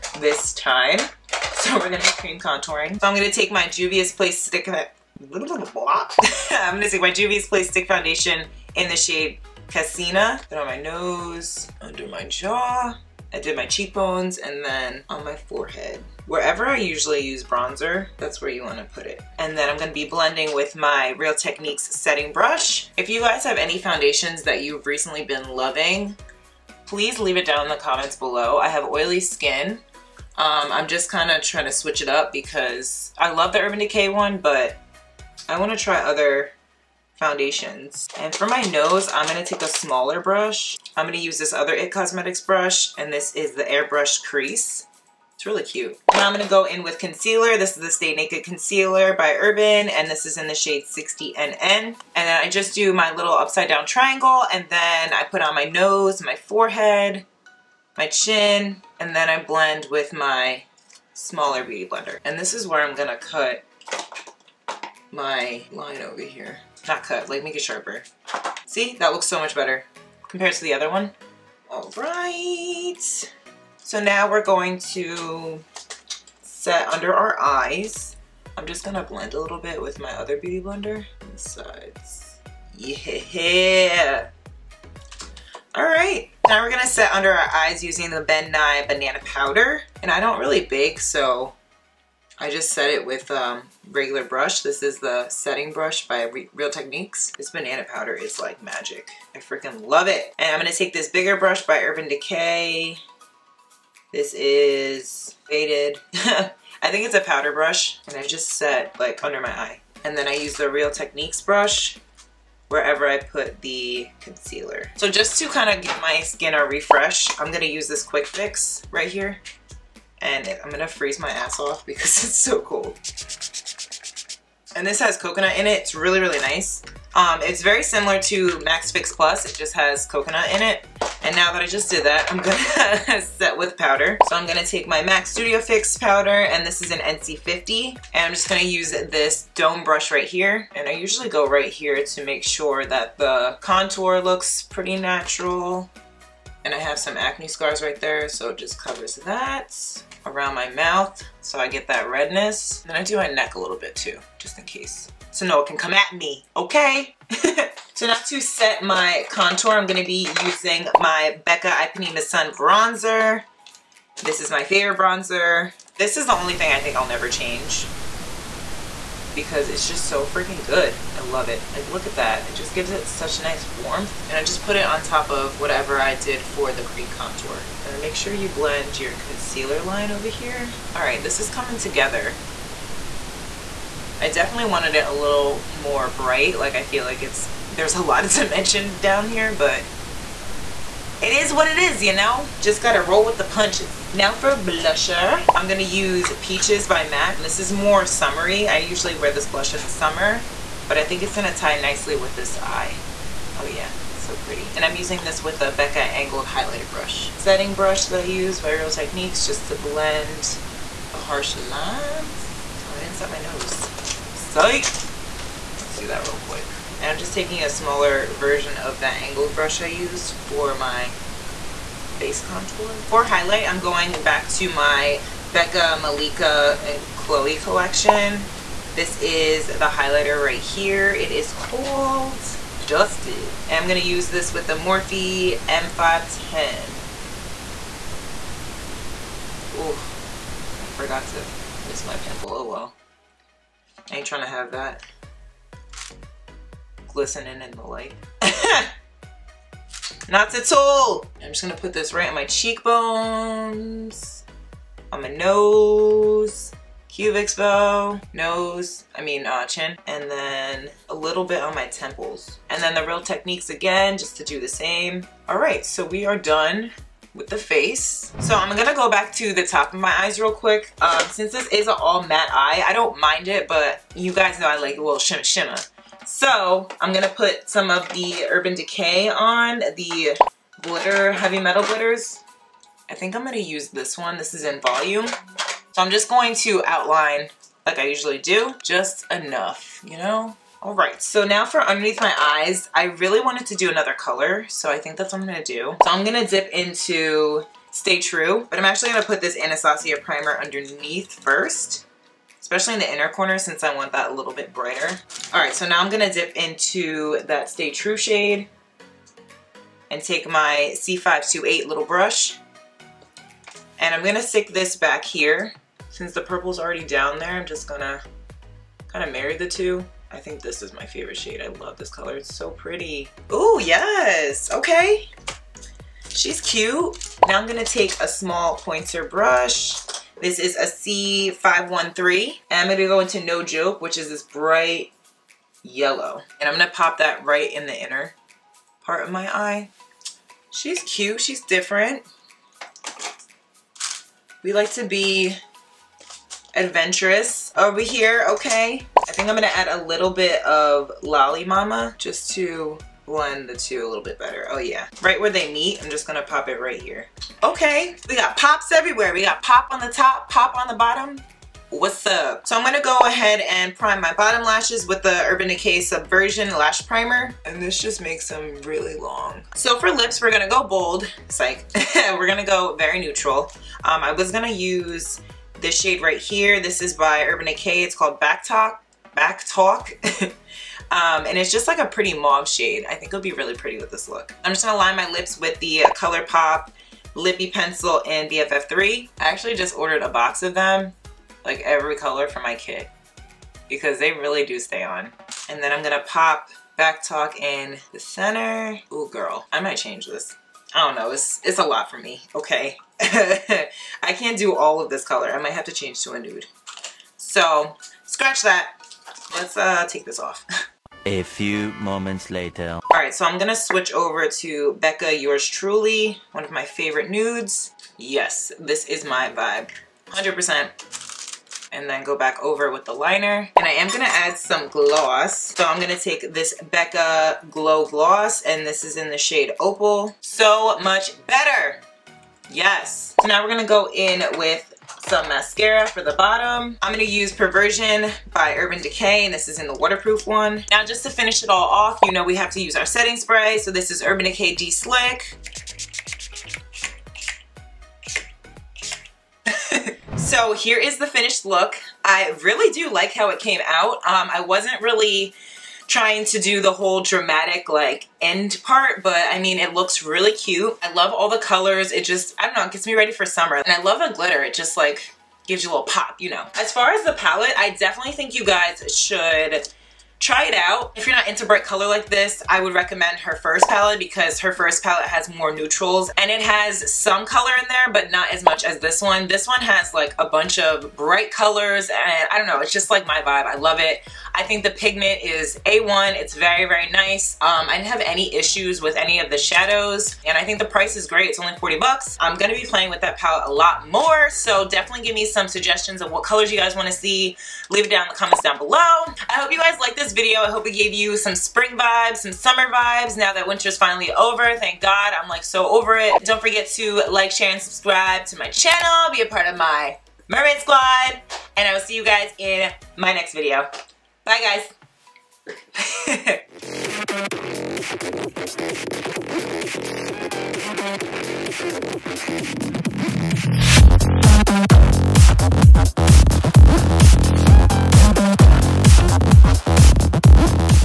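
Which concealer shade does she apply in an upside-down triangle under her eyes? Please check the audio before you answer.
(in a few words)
60NN.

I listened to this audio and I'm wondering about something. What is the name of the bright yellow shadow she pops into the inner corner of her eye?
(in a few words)
No Joke.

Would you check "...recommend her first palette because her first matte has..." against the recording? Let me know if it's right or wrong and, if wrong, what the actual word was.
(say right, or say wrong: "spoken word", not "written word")
wrong: "palette", not "matte".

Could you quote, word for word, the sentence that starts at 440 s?
Now, just to finish it all off, you know we have to use our setting spray.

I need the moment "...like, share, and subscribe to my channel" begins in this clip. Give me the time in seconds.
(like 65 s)
507 s.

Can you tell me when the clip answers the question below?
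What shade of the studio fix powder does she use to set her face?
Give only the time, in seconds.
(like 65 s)
136 s.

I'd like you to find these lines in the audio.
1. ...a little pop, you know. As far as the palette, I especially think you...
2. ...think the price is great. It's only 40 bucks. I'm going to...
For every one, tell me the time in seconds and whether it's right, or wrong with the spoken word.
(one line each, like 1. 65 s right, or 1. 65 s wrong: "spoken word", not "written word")
1. 465 s wrong: "definitely", not "especially"
2. 490 s right.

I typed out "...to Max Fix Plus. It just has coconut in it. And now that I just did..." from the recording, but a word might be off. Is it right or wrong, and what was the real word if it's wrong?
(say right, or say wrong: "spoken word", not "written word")
right.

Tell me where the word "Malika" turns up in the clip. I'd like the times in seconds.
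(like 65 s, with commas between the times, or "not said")
226 s.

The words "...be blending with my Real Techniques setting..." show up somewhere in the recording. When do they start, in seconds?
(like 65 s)
19 s.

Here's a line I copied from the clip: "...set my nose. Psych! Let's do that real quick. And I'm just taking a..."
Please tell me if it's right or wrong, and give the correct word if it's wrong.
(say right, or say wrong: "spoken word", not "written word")
right.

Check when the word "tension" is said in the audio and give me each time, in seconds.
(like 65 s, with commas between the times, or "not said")
not said.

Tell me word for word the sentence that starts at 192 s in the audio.
Just gotta roll with the punches.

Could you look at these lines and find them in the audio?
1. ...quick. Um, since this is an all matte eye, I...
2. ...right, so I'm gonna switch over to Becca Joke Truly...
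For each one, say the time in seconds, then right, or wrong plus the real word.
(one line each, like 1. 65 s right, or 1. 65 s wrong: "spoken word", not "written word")
1. 270 s right
2. 413 s wrong: "Yours", not "Joke".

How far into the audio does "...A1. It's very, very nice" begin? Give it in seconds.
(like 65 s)
485 s.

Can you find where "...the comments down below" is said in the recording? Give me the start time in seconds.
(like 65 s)
498 s.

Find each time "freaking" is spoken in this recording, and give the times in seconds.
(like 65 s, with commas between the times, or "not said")
99 s, 170 s.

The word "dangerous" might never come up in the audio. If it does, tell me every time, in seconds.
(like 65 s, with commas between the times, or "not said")
not said.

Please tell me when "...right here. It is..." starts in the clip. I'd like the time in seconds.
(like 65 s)
230 s.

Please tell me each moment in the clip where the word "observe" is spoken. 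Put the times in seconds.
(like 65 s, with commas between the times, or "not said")
not said.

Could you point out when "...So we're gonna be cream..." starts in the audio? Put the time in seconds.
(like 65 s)
1 s.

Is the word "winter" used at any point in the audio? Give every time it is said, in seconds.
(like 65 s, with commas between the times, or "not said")
503 s.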